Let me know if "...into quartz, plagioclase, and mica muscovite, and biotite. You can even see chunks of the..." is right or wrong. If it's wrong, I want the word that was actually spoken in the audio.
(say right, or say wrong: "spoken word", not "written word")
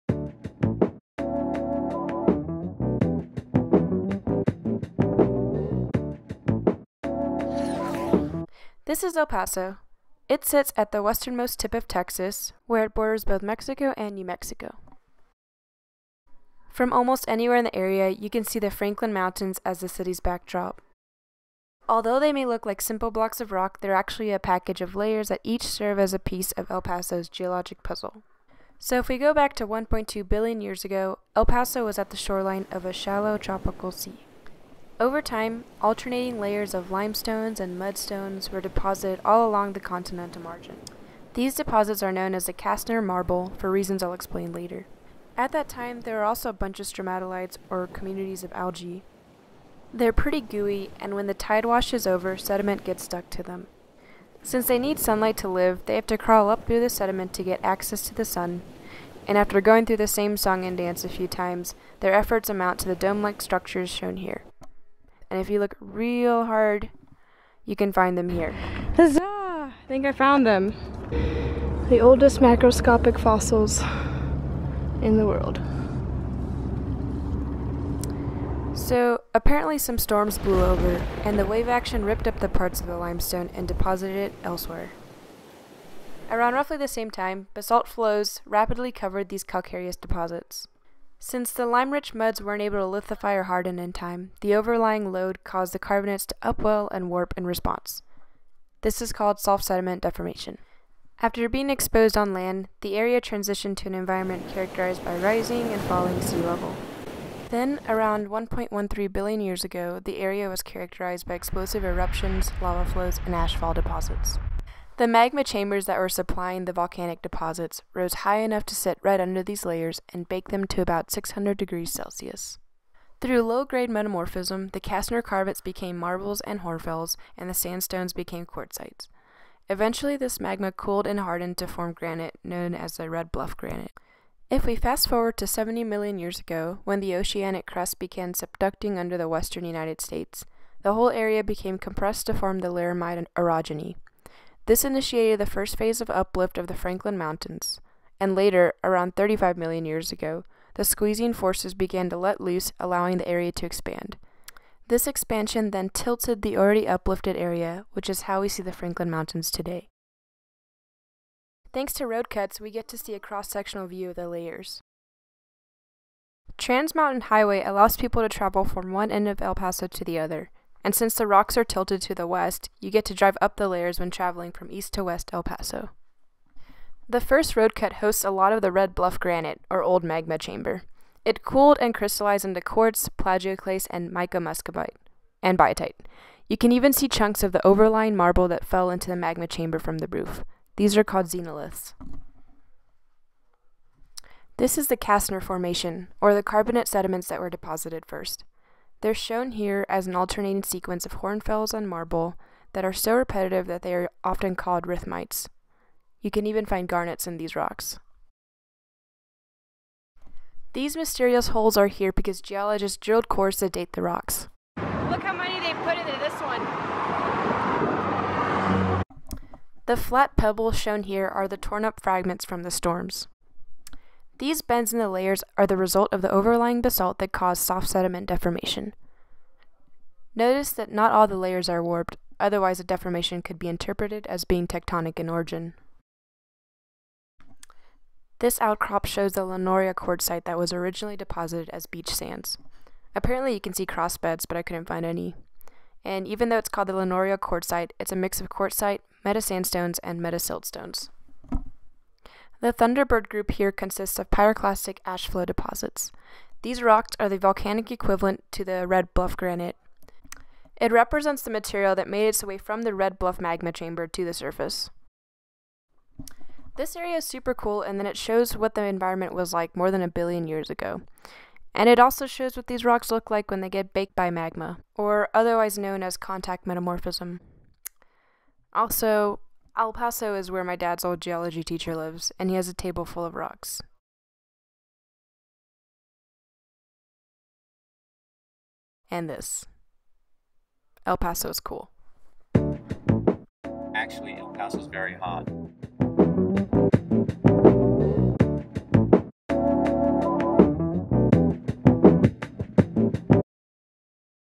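right.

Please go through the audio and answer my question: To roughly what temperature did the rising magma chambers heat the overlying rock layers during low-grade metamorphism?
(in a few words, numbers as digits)
600 degrees Celsius.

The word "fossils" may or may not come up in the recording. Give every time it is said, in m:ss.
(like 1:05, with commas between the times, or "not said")
1:13.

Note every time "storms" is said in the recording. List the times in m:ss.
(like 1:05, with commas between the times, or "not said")
1:19, 3:42.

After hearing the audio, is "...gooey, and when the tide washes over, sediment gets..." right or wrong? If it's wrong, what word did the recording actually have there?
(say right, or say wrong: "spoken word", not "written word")
right.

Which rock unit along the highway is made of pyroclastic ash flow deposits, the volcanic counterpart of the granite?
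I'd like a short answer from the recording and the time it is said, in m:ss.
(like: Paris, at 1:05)
Thunderbird group, at 4:12.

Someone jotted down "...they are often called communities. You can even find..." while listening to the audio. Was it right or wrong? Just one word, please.
wrong.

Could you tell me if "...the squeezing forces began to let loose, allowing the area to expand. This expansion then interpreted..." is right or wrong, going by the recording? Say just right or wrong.
wrong.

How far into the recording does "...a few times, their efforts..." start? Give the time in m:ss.
1:01.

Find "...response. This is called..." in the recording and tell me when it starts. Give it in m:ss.
1:37.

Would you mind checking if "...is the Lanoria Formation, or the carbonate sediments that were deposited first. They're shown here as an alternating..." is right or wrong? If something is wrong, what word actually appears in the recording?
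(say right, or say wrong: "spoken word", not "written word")
wrong: "Castner", not "Lanoria".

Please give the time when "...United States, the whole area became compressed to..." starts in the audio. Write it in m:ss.
2:19.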